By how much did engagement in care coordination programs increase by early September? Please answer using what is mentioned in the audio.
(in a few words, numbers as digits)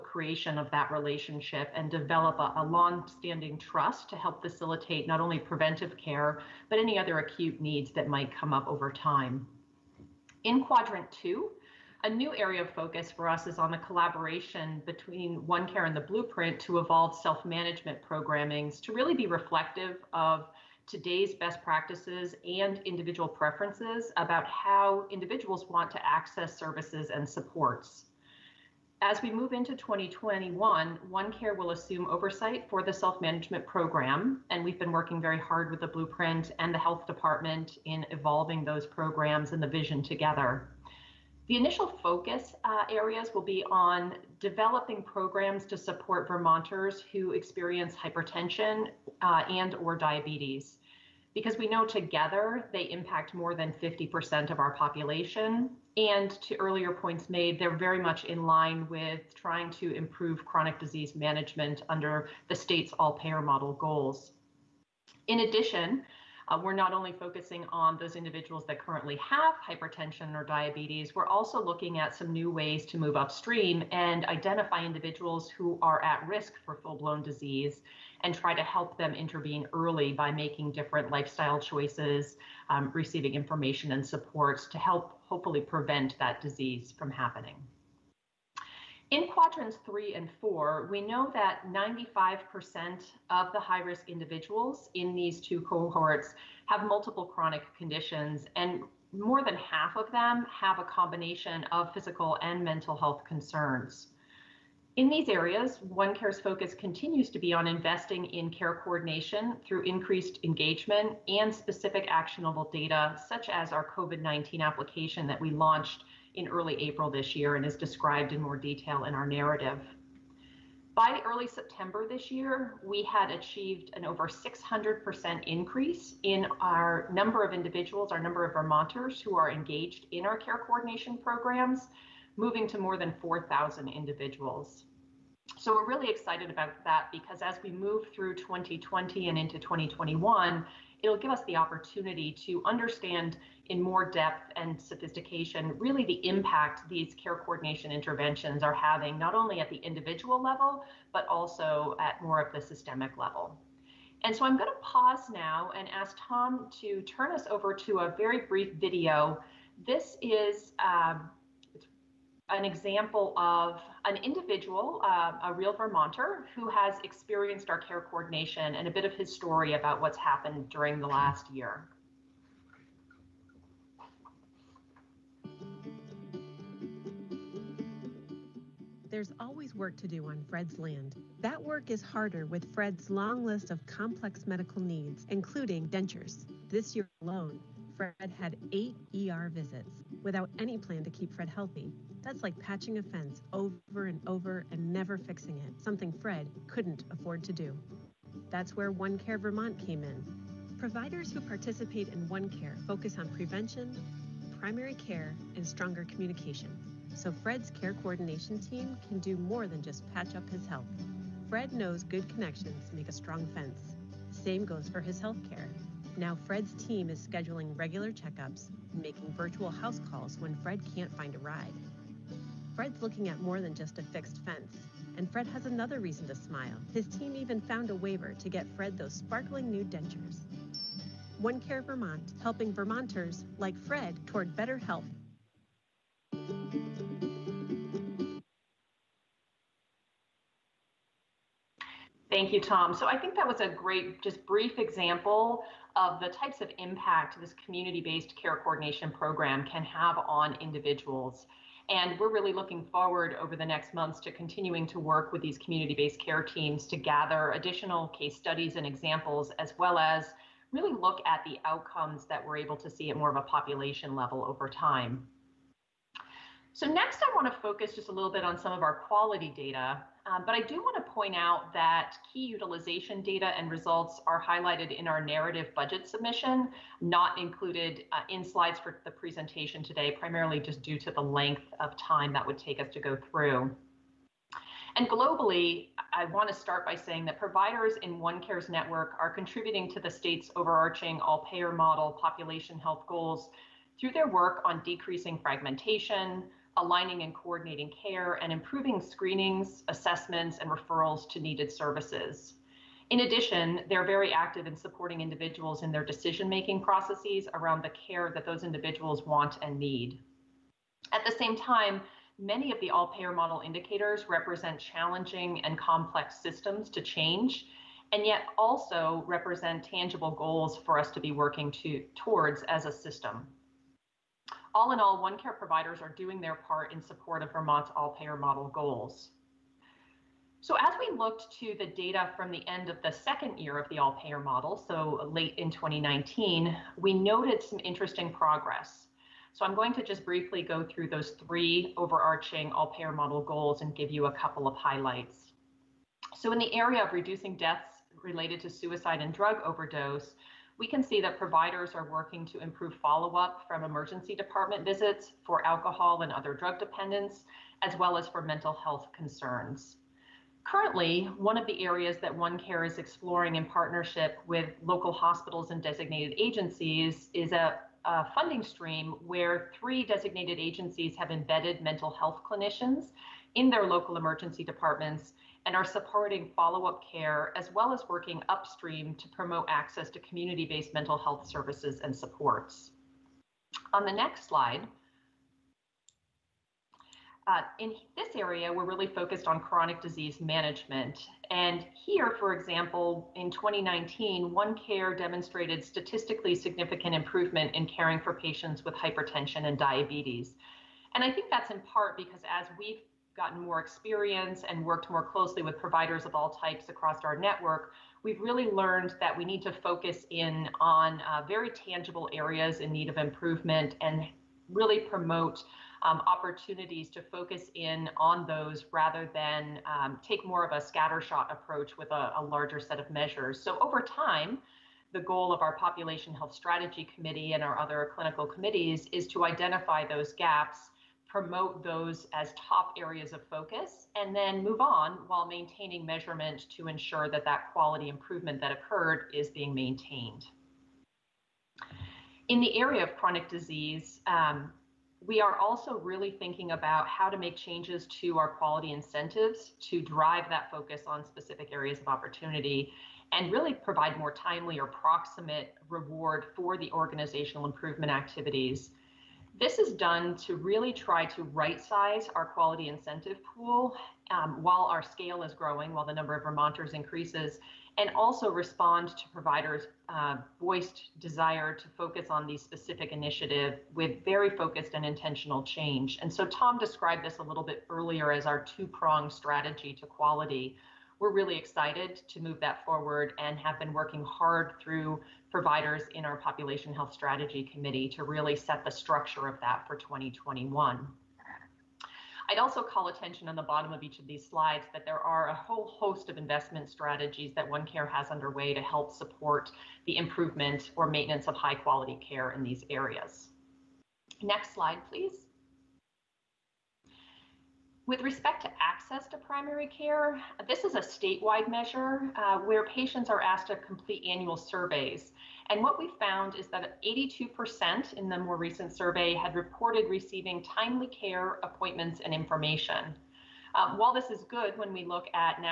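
over 600%.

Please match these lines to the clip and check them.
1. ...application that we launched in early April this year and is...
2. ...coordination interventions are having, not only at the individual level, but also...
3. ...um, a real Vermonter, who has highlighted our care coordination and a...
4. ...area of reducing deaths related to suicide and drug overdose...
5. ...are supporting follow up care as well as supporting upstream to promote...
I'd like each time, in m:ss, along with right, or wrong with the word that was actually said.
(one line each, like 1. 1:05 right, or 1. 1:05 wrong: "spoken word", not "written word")
1. 1:54 right
2. 2:27 right
3. 2:45 wrong: "experienced", not "highlighted"
4. 5:46 right
5. 6:15 wrong: "working", not "supporting".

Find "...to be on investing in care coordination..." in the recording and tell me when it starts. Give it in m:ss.
1:47.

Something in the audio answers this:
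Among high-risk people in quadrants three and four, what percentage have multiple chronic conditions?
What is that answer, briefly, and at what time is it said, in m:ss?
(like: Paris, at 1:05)
95%, at 1:31.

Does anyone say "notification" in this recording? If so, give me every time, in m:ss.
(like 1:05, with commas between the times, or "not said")
not said.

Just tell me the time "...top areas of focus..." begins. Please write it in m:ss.
7:12.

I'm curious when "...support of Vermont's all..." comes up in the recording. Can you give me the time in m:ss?
5:27.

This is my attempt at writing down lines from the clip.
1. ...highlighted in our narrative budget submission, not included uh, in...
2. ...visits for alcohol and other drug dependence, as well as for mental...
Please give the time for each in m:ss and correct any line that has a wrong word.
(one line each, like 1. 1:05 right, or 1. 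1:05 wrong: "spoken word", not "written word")
1. 4:34 right
2. 5:54 right.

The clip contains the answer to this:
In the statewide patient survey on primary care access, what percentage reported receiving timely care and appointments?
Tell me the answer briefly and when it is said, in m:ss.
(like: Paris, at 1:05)
82%, at 8:37.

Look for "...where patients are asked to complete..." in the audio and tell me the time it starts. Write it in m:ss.
8:32.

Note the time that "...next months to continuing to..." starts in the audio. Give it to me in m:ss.
4:13.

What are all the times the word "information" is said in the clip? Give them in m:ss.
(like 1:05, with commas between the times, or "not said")
1:23, 8:42.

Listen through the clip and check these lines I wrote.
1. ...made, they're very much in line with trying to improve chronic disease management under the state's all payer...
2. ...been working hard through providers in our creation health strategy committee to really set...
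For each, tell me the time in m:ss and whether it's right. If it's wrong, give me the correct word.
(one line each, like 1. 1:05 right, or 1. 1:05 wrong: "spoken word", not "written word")
1. 0:57 right
2. 8:03 wrong: "population", not "creation".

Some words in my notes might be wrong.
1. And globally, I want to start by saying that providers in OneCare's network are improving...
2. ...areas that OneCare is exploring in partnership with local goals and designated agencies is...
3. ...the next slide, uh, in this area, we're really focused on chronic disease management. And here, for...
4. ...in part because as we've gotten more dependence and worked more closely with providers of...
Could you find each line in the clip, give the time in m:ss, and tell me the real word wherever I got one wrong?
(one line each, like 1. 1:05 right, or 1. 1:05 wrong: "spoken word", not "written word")
1. 4:44 wrong: "contributing", not "improving"
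2. 6:01 wrong: "hospitals", not "goals"
3. 6:24 right
4. 6:41 wrong: "experience", not "dependence".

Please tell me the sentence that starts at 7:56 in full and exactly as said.
And so Tom described this a little bit earlier as our two-pronged strategy to quality.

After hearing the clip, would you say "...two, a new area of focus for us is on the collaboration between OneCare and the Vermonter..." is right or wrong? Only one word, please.
wrong.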